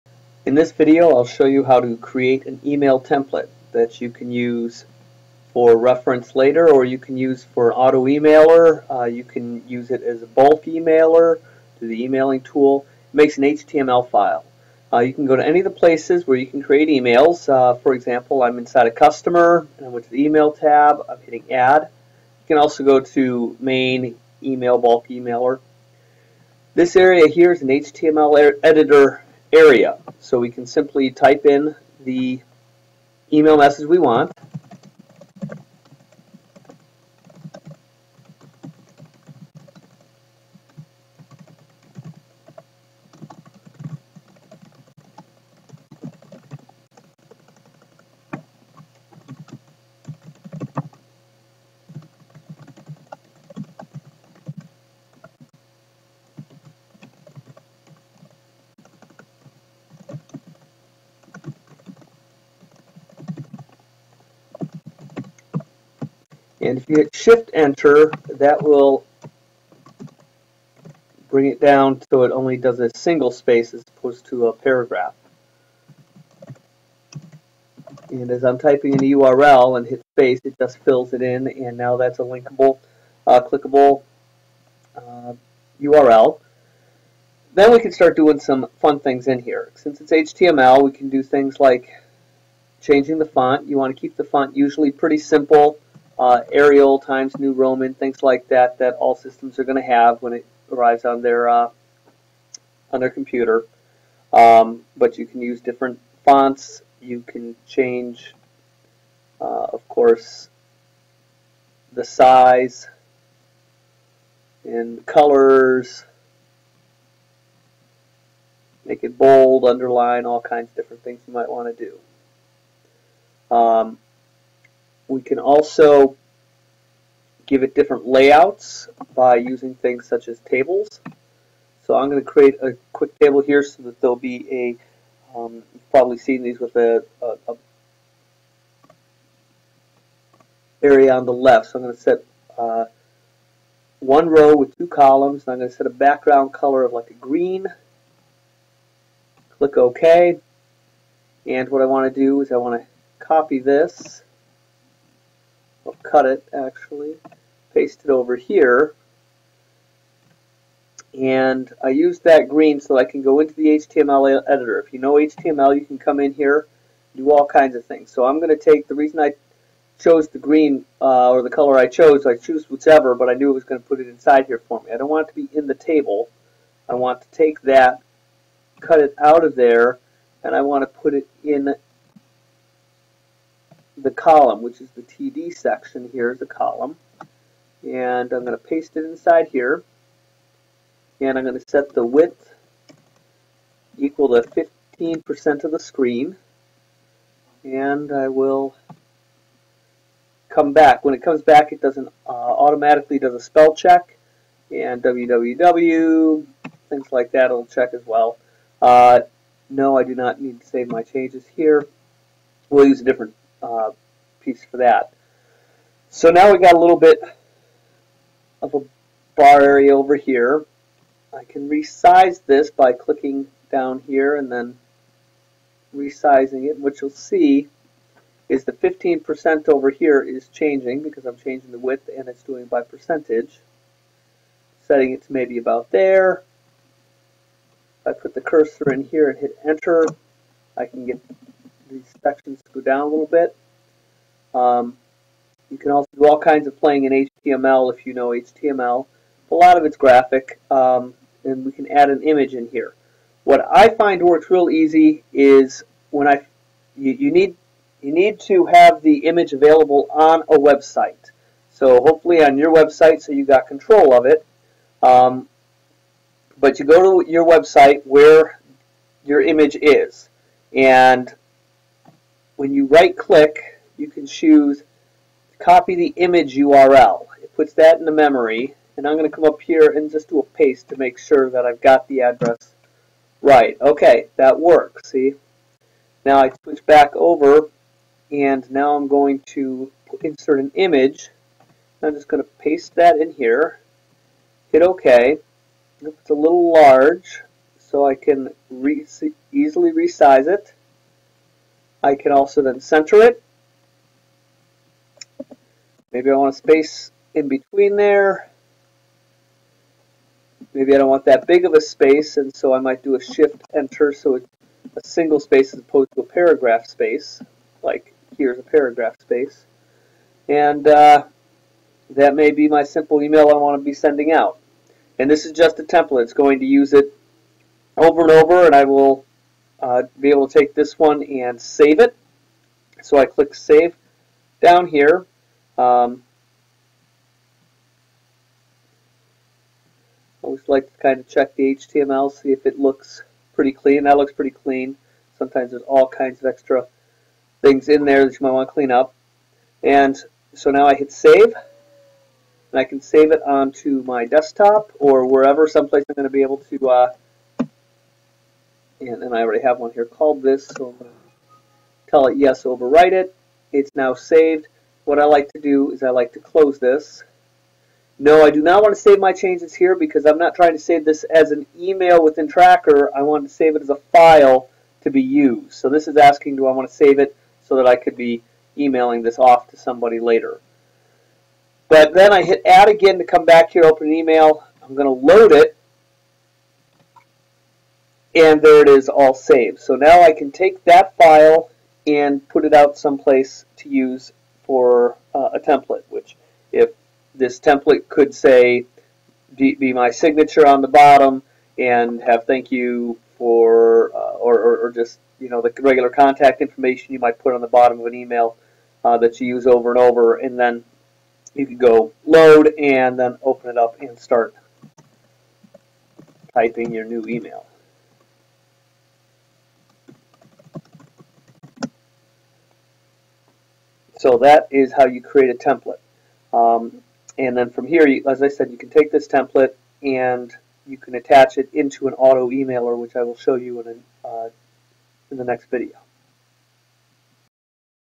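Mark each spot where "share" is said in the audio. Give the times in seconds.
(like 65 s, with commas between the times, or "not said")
not said.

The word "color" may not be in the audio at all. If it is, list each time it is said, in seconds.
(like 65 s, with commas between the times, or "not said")
115 s, 146 s, 171 s.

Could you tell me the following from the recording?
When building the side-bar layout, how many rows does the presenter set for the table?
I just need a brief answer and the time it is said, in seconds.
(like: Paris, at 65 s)
1, at 143 s.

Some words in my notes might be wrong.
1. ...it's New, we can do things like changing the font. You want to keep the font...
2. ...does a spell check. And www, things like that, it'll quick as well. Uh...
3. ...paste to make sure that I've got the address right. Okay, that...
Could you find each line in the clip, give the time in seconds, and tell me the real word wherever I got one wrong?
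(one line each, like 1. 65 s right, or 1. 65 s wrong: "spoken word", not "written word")
1. 89 s wrong: "HTML", not "New"
2. 203 s wrong: "check", not "quick"
3. 280 s right.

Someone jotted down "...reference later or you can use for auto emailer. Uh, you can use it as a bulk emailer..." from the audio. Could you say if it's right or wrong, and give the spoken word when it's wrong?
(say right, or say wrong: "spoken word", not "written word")
right.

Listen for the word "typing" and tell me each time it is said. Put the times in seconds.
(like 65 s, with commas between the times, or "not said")
78 s, 416 s.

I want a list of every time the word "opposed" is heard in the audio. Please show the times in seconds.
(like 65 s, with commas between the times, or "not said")
73 s, 315 s.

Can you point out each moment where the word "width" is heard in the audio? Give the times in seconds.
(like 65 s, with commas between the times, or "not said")
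192 s, 231 s.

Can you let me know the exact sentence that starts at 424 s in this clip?
So that is how you create a template.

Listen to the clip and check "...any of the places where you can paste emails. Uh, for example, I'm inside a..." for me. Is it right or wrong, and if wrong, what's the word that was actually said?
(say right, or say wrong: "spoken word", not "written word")
wrong: "create", not "paste".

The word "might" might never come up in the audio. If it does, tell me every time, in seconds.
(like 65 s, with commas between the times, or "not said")
121 s, 312 s, 348 s, 407 s.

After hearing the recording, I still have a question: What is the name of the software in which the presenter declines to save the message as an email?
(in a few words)
Trakker.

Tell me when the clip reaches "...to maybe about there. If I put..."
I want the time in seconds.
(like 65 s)
235 s.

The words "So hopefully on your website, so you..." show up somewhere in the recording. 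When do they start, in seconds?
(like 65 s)
261 s.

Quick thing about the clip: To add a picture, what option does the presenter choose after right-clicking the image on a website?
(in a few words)
copy the image URL.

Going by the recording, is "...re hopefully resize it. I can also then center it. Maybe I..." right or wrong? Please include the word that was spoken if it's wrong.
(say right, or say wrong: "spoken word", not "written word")
wrong: "easily", not "hopefully".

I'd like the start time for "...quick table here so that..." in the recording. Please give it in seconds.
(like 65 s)
132 s.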